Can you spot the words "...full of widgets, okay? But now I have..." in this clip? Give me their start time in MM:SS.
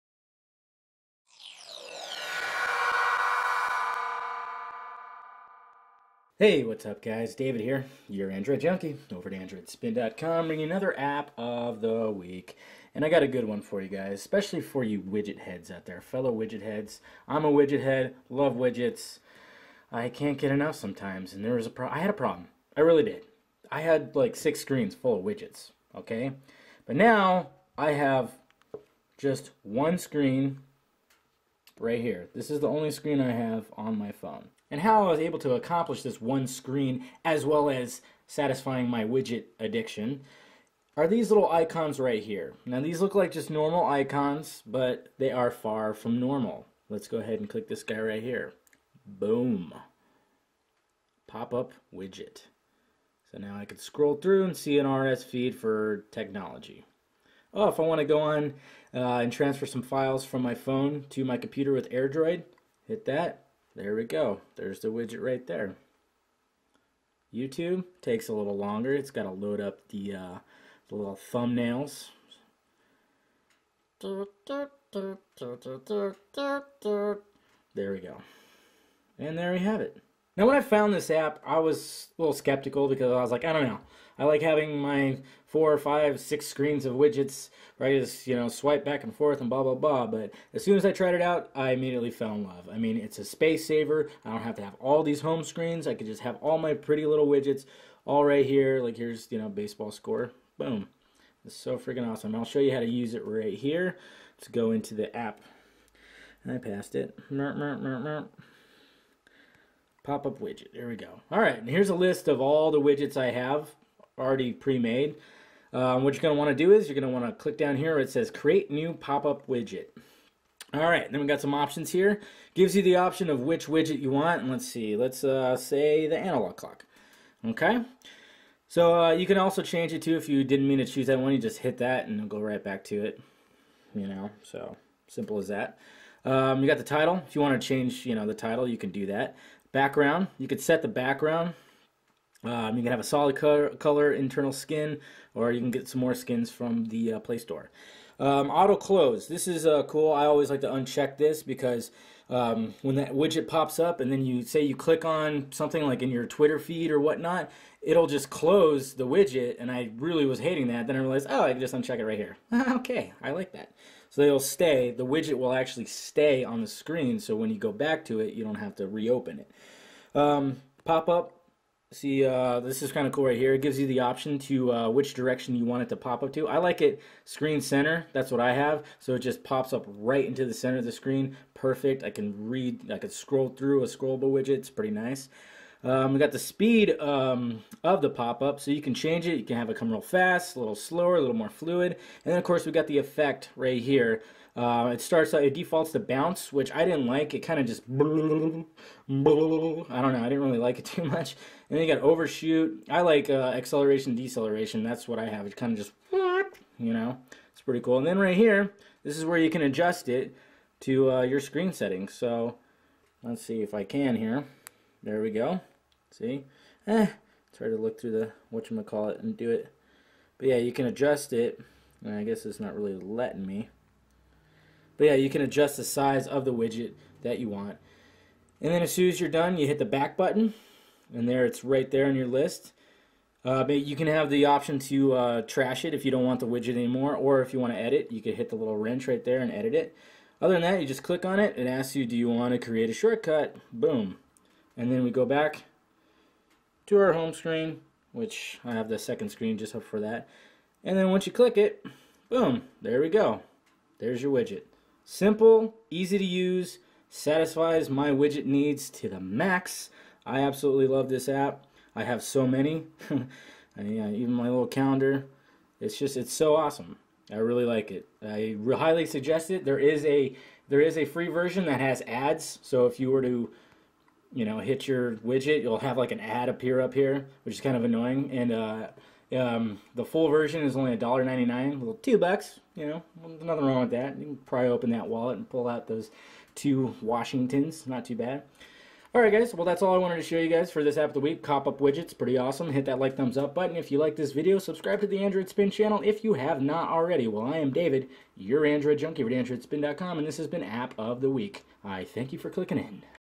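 00:24.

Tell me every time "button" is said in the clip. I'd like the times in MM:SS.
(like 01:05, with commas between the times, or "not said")
03:50, 04:53.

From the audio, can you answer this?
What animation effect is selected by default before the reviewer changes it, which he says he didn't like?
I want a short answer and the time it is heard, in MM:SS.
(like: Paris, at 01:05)
bounce, at 03:15.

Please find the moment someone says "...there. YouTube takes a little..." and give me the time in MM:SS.
01:05.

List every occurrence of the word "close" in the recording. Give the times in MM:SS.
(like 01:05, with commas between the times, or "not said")
02:28, 02:38.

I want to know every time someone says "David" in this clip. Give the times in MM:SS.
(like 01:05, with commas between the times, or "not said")
00:07, 04:57.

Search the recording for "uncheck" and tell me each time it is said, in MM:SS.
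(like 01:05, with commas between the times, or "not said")
02:30, 02:41.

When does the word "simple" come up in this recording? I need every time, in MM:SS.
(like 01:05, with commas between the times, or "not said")
02:15, 04:15.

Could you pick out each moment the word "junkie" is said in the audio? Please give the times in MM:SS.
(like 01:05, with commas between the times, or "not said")
00:08, 04:58.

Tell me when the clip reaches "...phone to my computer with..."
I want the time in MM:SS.
01:00.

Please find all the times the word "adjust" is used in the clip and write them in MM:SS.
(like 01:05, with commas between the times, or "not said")
03:29, 03:40, 03:45.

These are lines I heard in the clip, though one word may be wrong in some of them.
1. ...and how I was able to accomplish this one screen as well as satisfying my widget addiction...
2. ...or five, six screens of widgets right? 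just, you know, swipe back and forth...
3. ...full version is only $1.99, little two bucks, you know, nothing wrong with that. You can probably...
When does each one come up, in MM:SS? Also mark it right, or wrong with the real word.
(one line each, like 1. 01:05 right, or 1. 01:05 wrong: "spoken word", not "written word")
1. 00:34 right
2. 01:25 right
3. 04:40 right.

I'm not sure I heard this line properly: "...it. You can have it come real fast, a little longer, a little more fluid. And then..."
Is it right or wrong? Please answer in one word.
wrong.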